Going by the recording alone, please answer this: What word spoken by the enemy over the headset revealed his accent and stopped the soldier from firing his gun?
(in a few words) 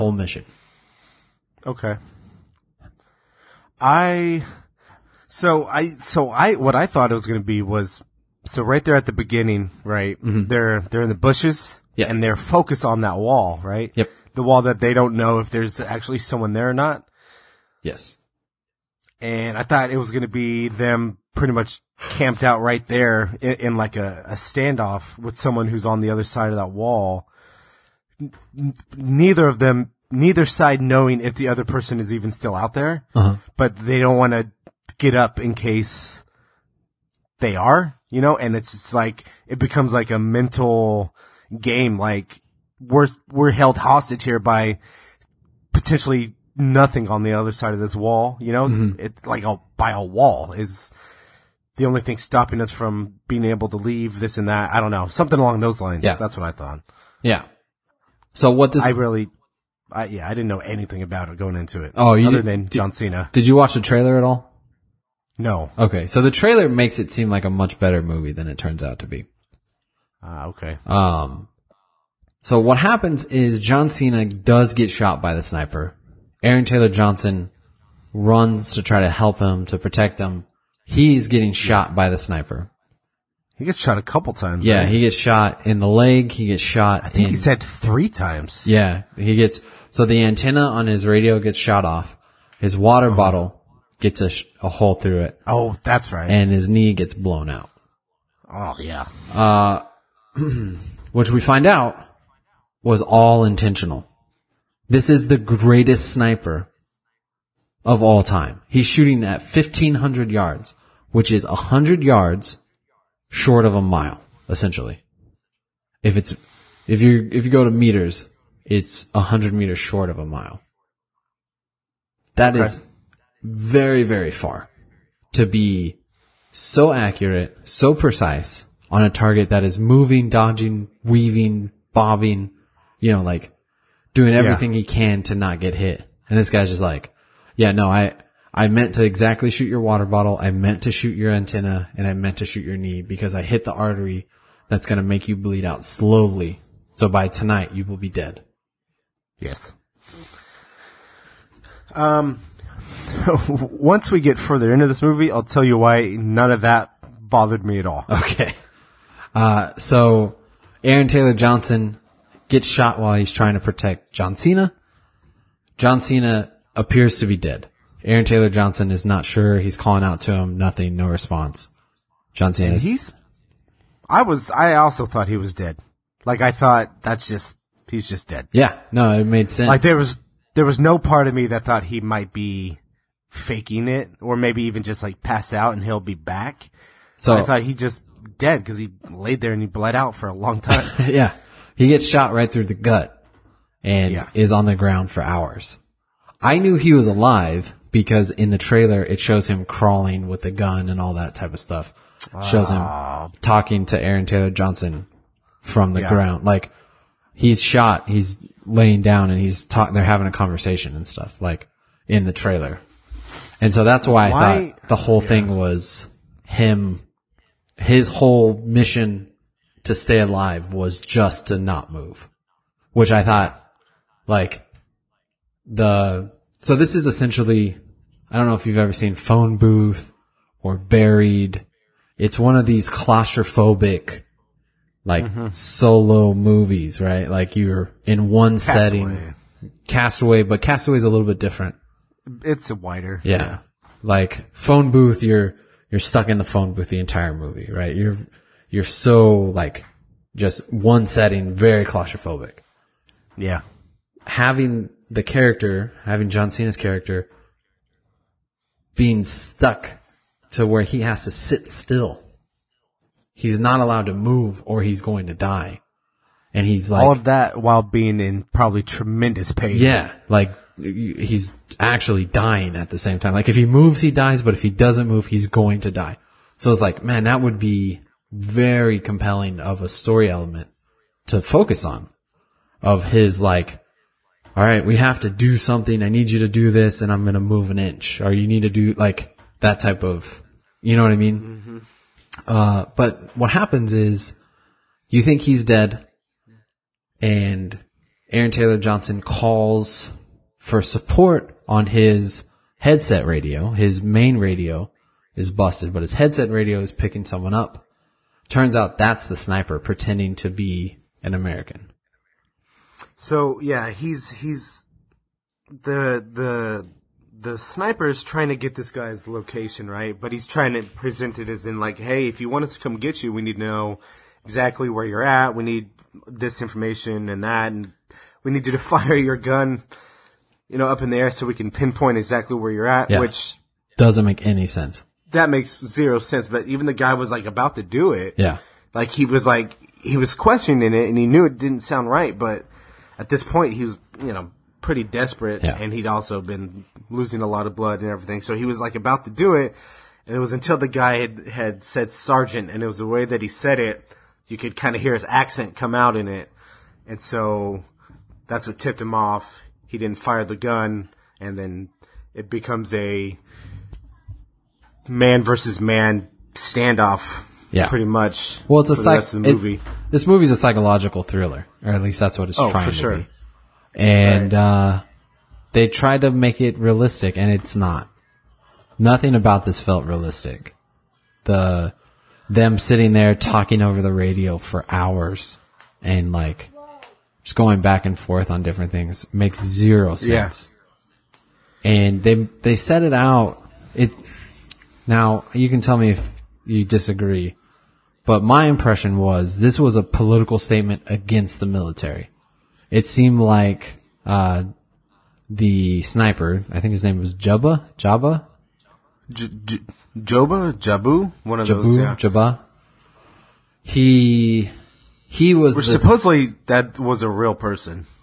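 sergeant.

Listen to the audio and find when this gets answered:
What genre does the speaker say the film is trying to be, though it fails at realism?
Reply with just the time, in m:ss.
6:10.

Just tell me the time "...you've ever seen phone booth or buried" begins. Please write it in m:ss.
3:48.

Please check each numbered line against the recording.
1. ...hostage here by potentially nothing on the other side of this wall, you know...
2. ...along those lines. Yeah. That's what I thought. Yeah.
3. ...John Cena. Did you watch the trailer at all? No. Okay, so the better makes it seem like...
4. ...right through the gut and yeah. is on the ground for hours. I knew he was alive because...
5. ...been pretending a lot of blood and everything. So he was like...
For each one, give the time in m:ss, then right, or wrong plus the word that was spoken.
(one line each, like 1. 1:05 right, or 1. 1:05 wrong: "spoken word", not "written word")
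1. 0:43 right
2. 0:55 right
3. 1:02 wrong: "trailer", not "better"
4. 3:12 right
5. 5:46 wrong: "losing", not "pretending".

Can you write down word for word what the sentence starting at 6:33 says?
It now you can tell me if you disagree, but my impression was this was a political statement against the military.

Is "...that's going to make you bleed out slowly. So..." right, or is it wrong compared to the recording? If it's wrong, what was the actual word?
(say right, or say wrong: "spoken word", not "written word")
right.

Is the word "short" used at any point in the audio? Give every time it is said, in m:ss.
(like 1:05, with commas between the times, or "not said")
1:53, 1:59.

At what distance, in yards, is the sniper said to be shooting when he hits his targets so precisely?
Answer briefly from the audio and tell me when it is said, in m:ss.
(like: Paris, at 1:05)
1500 yards, at 1:49.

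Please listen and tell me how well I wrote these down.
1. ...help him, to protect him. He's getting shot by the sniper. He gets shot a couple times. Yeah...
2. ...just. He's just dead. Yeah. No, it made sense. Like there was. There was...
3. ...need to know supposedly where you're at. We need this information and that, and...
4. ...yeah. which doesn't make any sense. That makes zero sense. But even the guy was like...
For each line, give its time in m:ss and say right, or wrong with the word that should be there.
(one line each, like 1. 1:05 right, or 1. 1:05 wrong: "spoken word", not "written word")
1. 1:19 right
2. 2:57 right
3. 5:23 wrong: "exactly", not "supposedly"
4. 5:33 right.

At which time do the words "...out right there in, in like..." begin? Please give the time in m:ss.
0:22.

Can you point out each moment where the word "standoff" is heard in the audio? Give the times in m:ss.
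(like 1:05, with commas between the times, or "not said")
0:24, 6:06.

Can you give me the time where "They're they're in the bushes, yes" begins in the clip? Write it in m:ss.
0:10.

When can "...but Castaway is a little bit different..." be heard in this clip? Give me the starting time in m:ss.
4:00.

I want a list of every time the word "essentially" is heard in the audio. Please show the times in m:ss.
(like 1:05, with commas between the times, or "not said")
1:54, 3:47.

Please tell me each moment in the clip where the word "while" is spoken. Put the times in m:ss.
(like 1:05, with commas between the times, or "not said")
2:42, 4:27.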